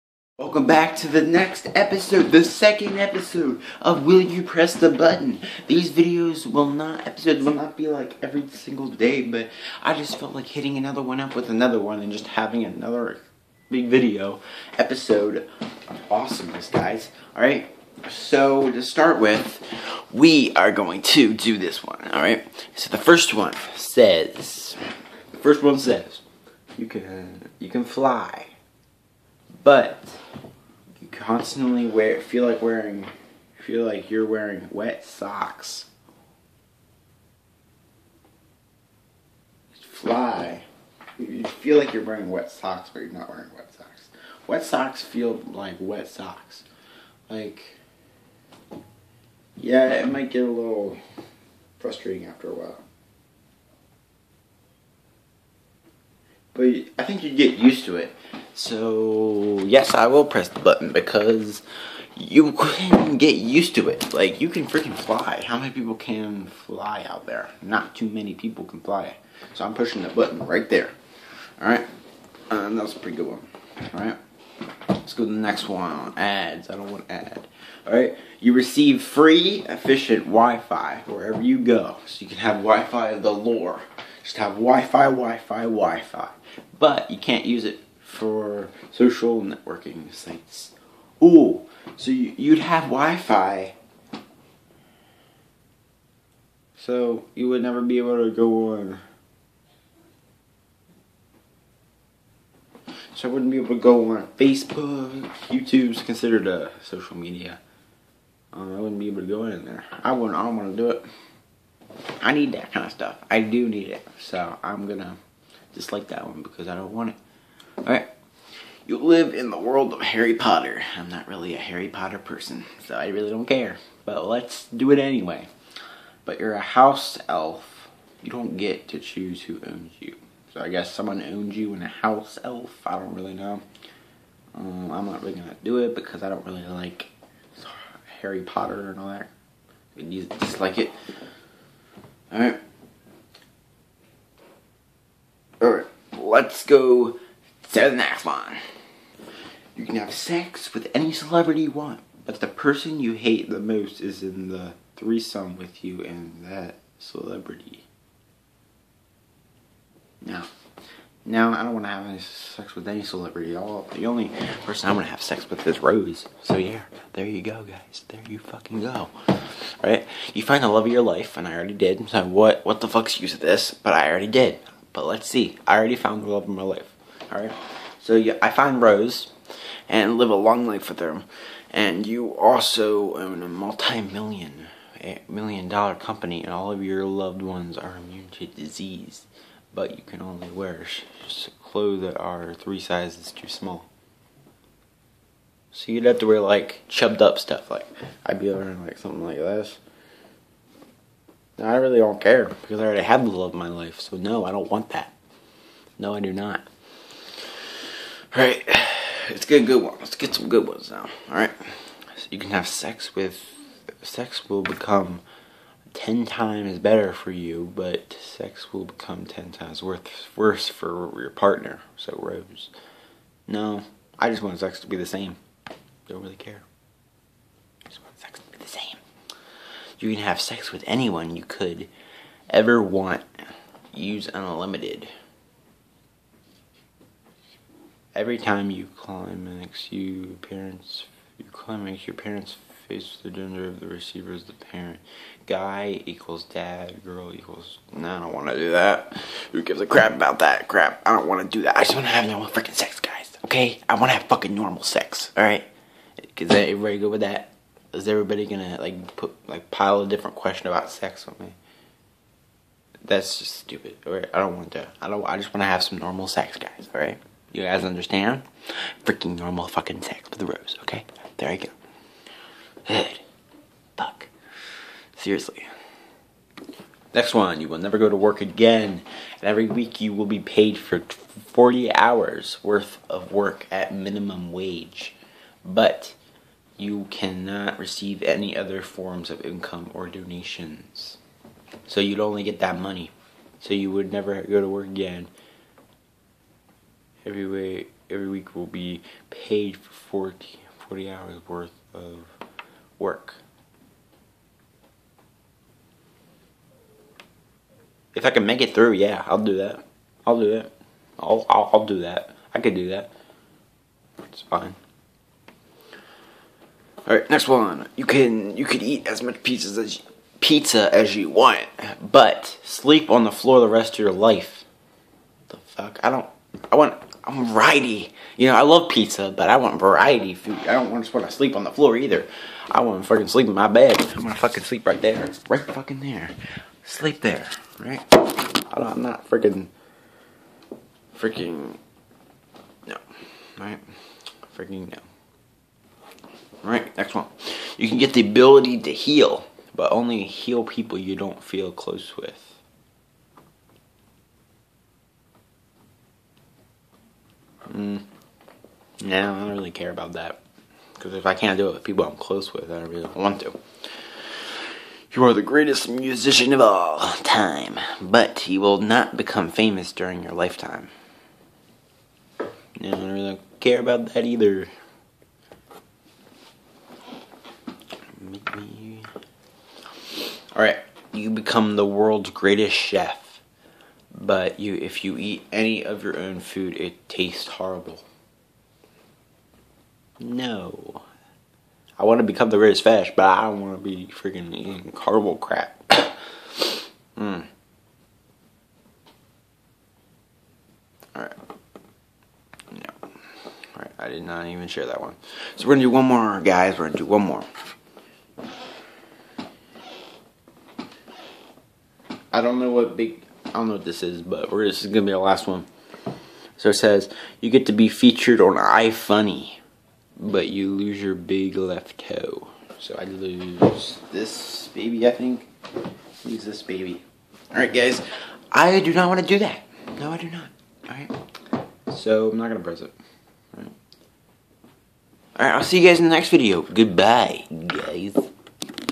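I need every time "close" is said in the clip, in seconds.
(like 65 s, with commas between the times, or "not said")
351 s, 362 s.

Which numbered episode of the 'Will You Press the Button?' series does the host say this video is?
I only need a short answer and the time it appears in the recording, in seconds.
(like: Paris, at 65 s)
second, at 2 s.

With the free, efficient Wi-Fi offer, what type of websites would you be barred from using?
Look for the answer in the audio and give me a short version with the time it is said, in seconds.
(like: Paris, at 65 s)
social networking sites, at 88 s.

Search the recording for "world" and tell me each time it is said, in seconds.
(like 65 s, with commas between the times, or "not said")
119 s, 381 s.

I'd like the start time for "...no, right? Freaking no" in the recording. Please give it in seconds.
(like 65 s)
342 s.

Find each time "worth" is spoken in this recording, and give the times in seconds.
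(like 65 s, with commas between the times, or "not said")
282 s, 301 s.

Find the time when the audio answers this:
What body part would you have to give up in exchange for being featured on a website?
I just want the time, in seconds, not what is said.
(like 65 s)
421 s.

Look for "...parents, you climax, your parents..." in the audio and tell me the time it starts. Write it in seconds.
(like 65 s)
240 s.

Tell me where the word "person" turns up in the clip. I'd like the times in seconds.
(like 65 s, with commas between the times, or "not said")
122 s, 152 s, 164 s.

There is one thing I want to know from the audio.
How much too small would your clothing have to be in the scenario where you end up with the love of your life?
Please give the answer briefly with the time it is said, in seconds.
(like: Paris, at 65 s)
3 sizes, at 192 s.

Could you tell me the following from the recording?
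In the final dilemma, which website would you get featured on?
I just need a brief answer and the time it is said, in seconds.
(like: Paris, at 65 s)
iFunny, at 418 s.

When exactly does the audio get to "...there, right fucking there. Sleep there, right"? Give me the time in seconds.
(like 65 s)
335 s.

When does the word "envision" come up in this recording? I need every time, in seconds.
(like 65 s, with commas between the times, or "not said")
not said.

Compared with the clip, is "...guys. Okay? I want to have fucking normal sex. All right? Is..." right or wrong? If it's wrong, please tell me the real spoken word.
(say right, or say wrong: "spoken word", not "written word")
right.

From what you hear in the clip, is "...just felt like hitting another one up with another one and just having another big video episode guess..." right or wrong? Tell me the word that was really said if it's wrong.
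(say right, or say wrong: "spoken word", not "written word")
wrong: "awesomeness", not "guess".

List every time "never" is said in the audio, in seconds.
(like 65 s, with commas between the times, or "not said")
97 s, 277 s, 294 s.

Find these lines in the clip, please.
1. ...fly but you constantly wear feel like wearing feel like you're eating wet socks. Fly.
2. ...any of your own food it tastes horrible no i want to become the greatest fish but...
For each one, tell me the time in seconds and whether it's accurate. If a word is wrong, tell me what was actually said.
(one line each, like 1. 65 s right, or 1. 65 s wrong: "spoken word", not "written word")
1. 27 s wrong: "wearing", not "eating"
2. 385 s right.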